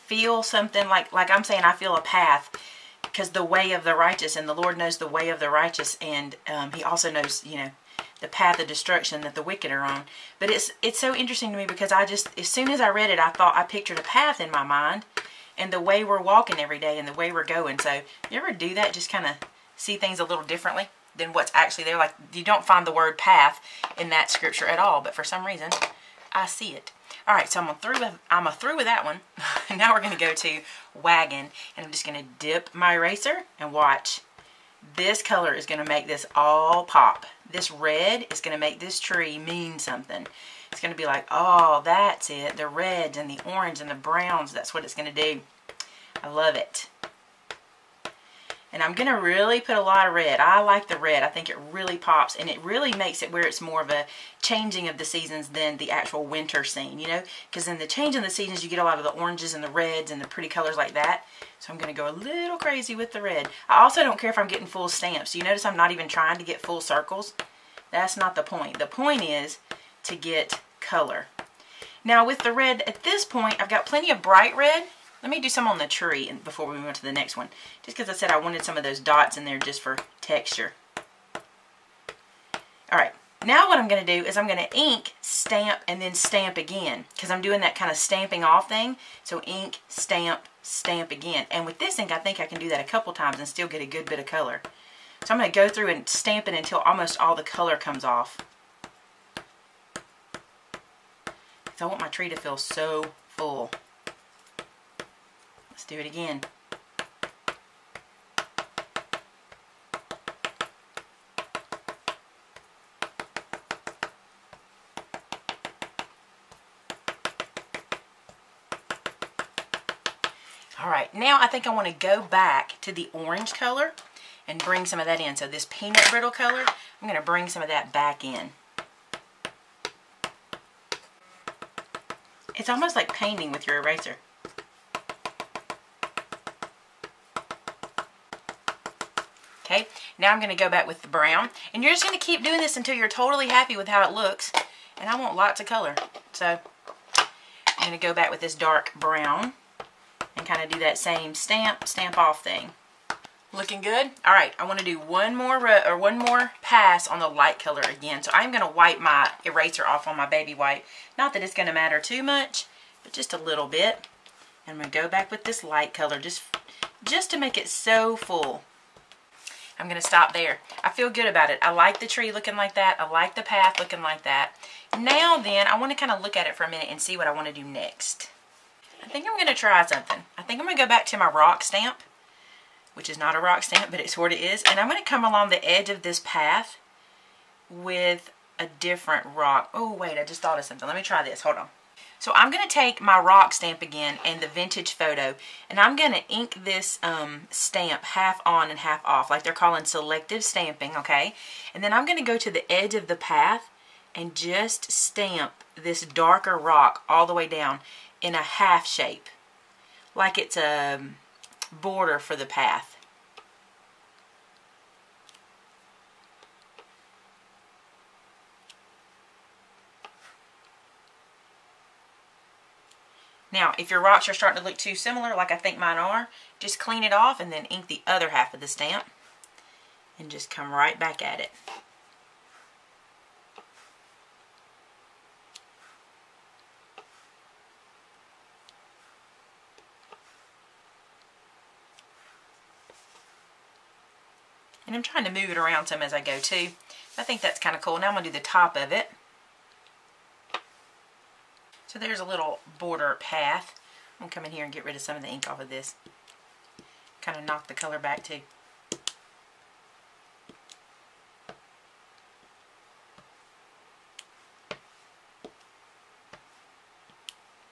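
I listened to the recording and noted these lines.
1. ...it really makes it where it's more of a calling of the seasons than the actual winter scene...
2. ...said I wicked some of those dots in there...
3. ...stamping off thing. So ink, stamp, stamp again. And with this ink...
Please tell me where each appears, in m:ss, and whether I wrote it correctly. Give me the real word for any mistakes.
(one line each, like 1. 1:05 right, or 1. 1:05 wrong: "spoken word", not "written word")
1. 0:52 wrong: "changing", not "calling"
2. 1:18 wrong: "wanted", not "wicked"
3. 1:27 right.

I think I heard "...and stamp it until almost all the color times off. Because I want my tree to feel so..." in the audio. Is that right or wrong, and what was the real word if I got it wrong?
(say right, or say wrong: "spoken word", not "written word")
wrong: "comes", not "times".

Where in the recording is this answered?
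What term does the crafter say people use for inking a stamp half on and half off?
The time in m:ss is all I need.
3:19.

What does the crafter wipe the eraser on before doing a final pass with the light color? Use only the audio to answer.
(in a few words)
Baby wipe.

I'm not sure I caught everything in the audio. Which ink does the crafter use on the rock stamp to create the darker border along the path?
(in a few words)
Vintage photo.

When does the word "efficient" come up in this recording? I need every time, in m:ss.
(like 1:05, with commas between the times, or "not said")
not said.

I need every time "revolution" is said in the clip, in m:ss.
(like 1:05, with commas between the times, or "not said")
not said.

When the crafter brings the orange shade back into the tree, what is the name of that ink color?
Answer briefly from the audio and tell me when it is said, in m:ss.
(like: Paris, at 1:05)
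Peanut brittle, at 2:05.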